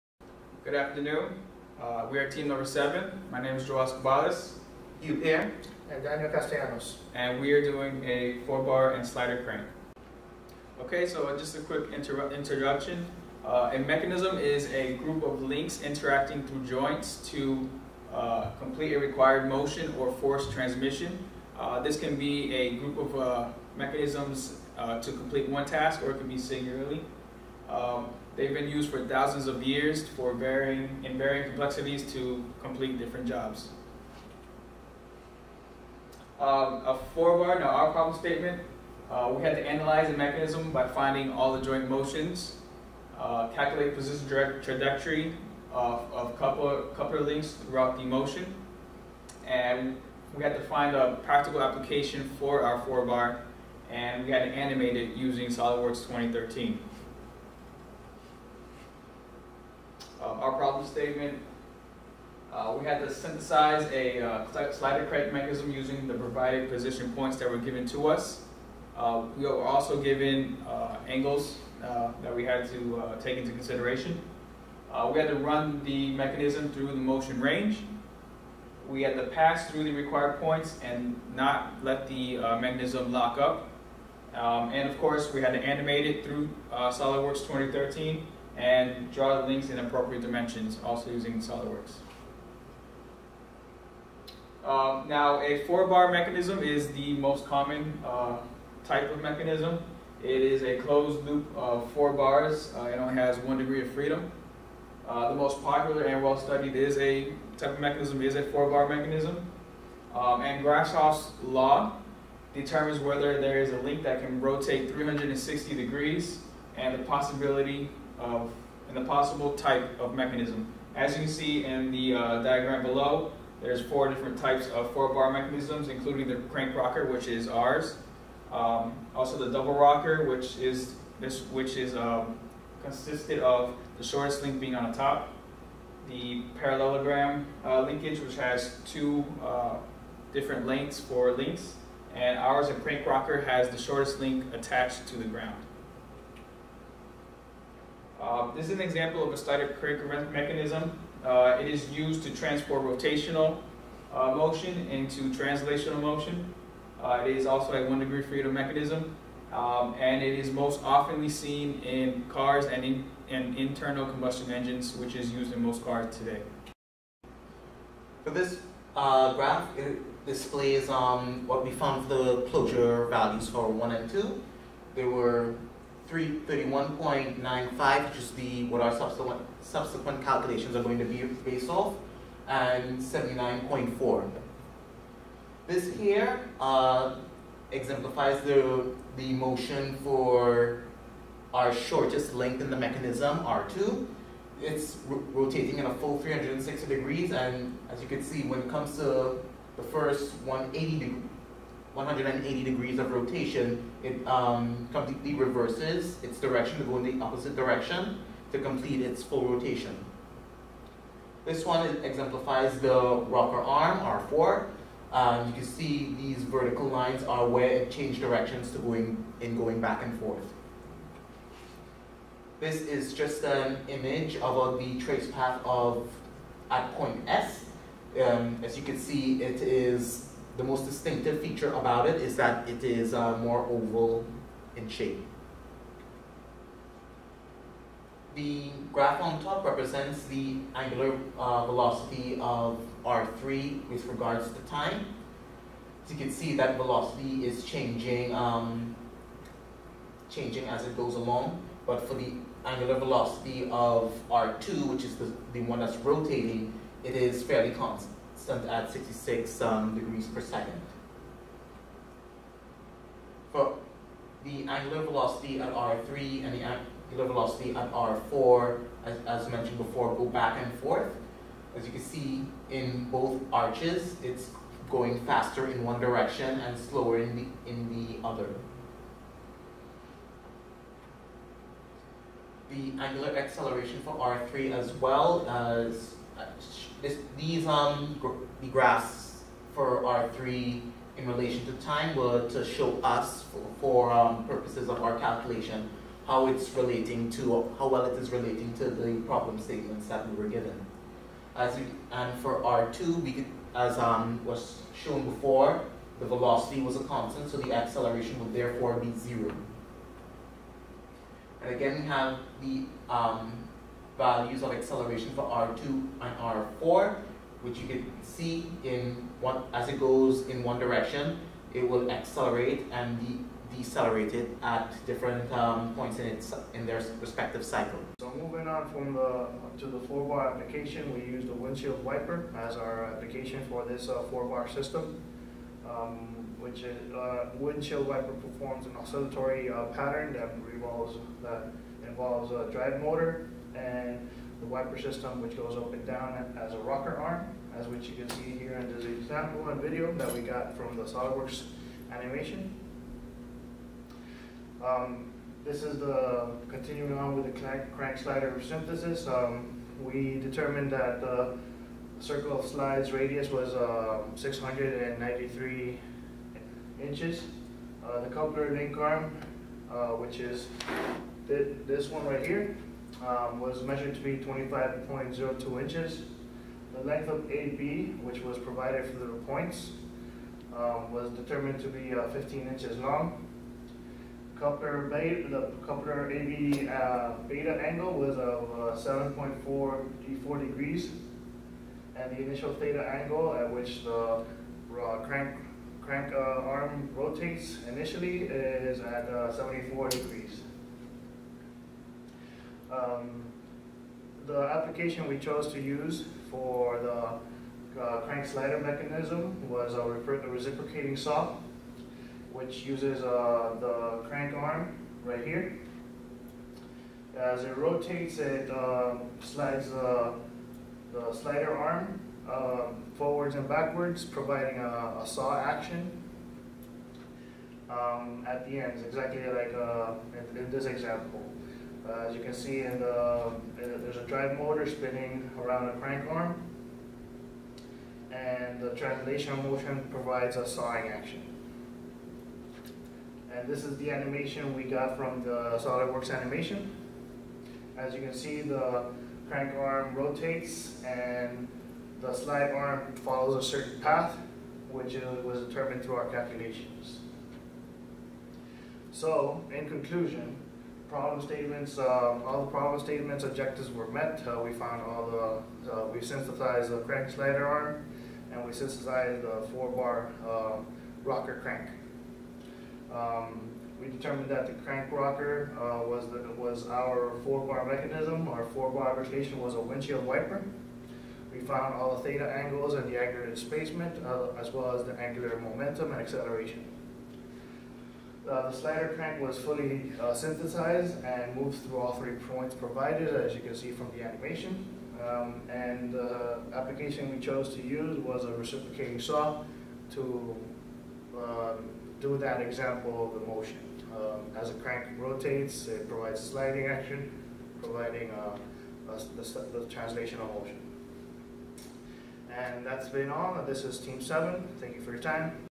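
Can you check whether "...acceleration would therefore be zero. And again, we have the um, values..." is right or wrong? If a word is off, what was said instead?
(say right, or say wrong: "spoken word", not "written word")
right.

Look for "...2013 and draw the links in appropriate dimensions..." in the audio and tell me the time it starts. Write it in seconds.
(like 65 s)
87 s.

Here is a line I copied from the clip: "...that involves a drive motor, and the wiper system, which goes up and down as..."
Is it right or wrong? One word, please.
right.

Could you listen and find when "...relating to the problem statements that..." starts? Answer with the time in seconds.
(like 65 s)
298 s.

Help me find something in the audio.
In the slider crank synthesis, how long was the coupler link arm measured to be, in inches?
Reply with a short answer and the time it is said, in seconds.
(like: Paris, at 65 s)
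25.02 inches, at 374 s.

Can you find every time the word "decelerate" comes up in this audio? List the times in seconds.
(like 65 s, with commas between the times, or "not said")
323 s.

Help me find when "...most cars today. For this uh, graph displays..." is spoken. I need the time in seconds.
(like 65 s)
165 s.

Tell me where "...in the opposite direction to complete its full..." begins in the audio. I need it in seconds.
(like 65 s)
206 s.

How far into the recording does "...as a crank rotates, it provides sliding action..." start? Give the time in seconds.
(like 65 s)
504 s.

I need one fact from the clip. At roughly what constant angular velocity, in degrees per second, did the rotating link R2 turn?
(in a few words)
66.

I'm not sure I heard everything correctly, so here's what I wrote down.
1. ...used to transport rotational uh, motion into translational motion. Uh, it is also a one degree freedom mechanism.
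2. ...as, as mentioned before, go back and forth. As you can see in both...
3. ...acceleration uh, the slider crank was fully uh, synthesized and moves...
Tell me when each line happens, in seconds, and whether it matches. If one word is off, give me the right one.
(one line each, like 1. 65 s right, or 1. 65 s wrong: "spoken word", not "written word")
1. 151 s right
2. 269 s right
3. 486 s right.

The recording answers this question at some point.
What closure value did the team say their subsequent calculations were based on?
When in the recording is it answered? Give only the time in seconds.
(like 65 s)
176 s.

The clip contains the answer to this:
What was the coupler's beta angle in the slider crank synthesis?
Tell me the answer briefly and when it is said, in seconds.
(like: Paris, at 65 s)
7.44 degrees, at 389 s.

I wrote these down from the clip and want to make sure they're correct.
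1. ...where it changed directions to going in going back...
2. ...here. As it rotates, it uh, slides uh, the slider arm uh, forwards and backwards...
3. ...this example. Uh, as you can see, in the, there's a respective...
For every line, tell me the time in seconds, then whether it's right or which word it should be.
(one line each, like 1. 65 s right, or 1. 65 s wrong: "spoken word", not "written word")
1. 217 s right
2. 415 s right
3. 430 s wrong: "drive", not "respective".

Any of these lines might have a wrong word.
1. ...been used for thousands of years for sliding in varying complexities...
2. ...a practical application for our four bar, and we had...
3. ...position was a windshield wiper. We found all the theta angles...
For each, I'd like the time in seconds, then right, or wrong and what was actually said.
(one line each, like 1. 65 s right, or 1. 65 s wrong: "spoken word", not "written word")
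1. 28 s wrong: "varying", not "sliding"
2. 50 s right
3. 479 s wrong: "rotation", not "position".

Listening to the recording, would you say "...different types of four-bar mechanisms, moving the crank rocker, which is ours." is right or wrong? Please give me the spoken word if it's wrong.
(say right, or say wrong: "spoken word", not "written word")
wrong: "including", not "moving".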